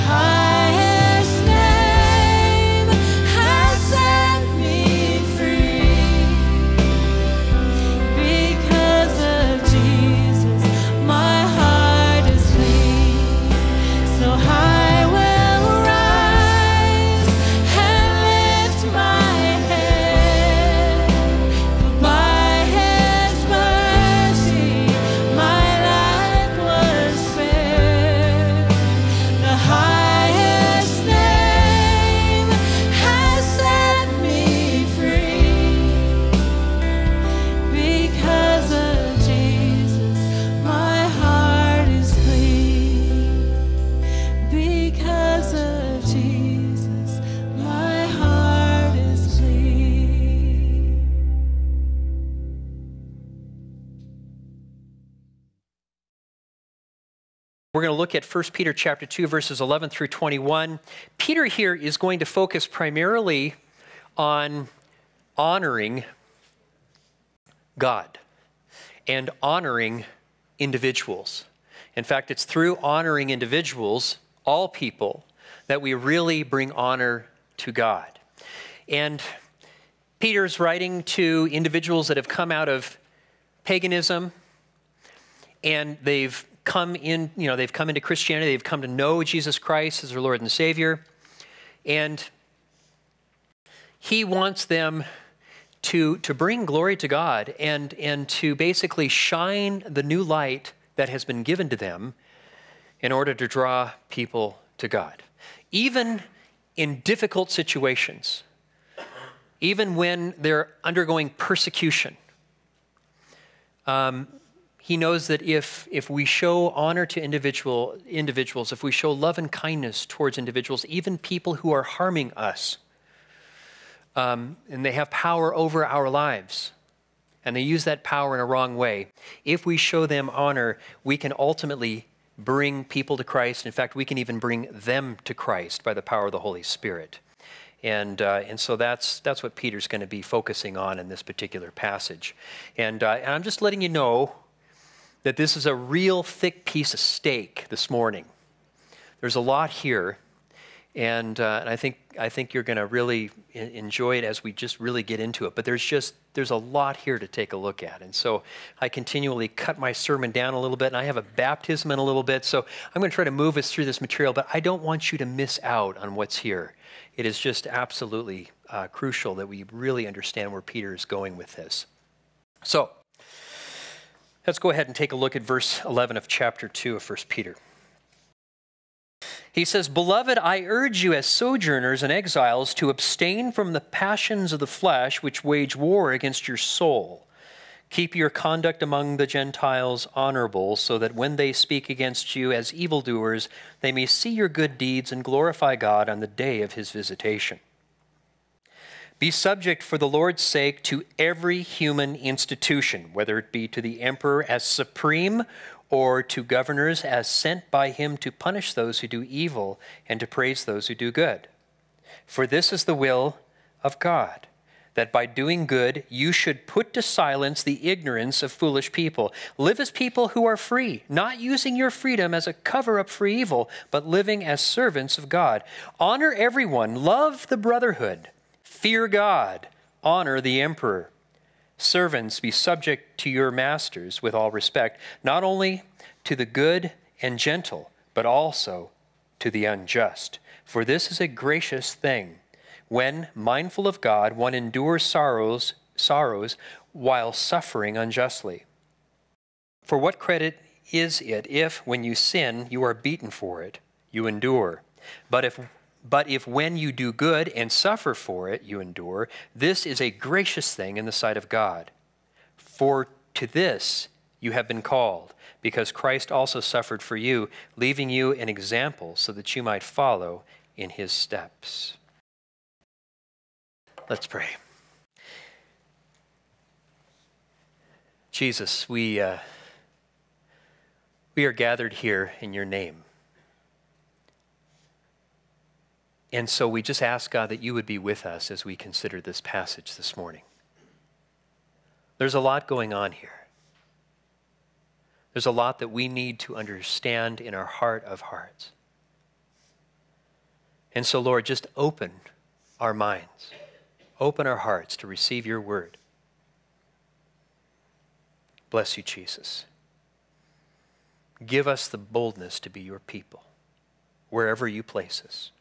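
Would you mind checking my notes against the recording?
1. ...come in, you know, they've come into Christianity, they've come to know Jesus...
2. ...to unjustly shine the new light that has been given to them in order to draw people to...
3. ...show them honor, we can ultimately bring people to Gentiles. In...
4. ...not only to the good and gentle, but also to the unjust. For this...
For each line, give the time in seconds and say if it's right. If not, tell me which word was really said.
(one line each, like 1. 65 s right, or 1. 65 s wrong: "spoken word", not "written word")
1. 86 s right
2. 98 s wrong: "basically", not "unjustly"
3. 129 s wrong: "Christ", not "Gentiles"
4. 235 s right.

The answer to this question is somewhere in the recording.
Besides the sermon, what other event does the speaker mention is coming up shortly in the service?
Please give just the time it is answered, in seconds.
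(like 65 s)
161 s.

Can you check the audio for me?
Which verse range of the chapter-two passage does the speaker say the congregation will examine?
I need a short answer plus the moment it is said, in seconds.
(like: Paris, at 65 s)
11 through 21, at 59 s.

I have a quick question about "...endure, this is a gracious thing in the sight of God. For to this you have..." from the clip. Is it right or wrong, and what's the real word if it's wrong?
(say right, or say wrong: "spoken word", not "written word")
right.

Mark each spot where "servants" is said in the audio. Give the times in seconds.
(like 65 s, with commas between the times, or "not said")
224 s, 231 s.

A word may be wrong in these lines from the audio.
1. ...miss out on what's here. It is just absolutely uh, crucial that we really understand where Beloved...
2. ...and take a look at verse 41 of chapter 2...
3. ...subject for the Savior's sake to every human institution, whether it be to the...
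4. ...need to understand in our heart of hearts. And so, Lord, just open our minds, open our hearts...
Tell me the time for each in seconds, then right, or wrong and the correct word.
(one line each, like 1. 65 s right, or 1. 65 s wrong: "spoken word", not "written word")
1. 165 s wrong: "Peter", not "Beloved"
2. 174 s wrong: "11", not "41"
3. 199 s wrong: "Lord", not "Savior"
4. 296 s right.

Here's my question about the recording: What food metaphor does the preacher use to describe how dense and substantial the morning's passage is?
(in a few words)
thick piece of steak.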